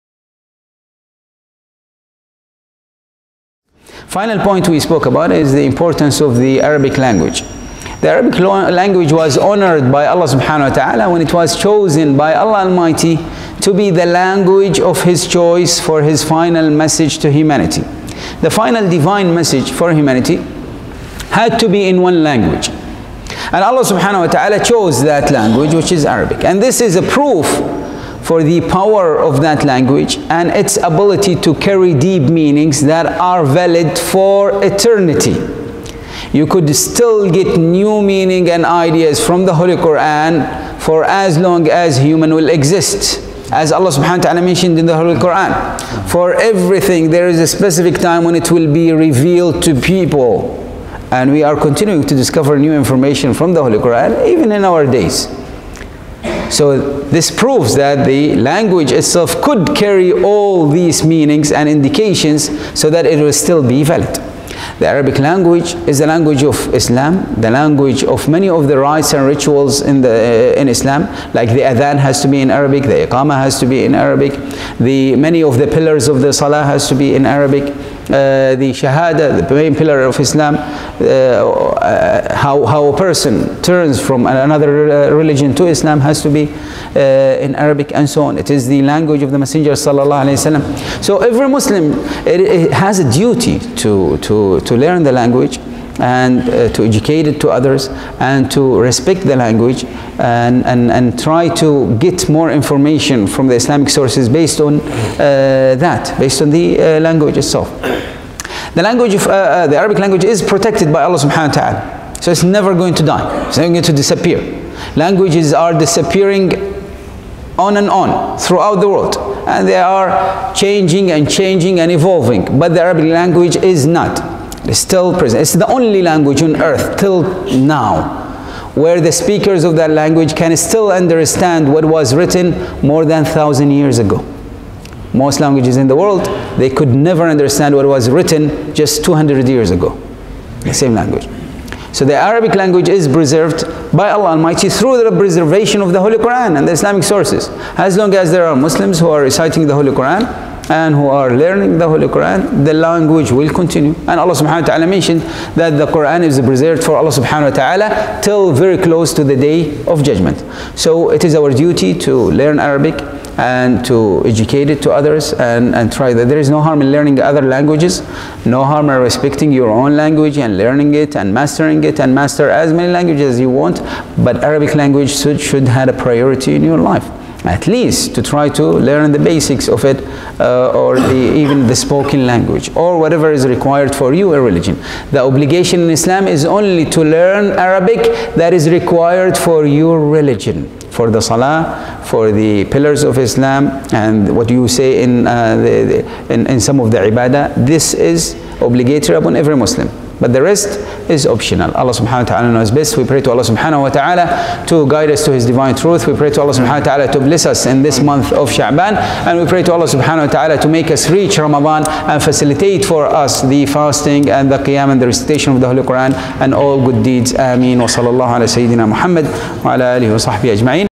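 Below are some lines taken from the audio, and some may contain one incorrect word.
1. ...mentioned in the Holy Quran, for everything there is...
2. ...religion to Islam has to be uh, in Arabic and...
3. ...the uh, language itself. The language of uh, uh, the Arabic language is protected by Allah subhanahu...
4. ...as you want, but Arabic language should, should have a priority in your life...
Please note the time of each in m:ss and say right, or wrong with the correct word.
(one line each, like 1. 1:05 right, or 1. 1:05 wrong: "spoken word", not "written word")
1. 0:44 right
2. 1:25 right
3. 1:46 right
4. 2:53 right.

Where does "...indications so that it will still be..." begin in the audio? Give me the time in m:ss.
1:01.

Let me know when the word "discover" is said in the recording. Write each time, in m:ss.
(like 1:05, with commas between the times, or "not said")
0:52.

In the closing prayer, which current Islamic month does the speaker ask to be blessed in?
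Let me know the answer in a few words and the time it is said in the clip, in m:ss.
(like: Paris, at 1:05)
Sha'ban, at 3:28.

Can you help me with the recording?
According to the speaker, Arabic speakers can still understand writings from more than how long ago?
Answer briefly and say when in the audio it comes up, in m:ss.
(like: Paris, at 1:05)
thousand years, at 2:13.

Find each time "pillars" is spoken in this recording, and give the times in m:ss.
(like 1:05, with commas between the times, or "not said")
1:15, 1:19, 3:12.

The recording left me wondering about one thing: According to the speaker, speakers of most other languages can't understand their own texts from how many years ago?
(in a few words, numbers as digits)
200.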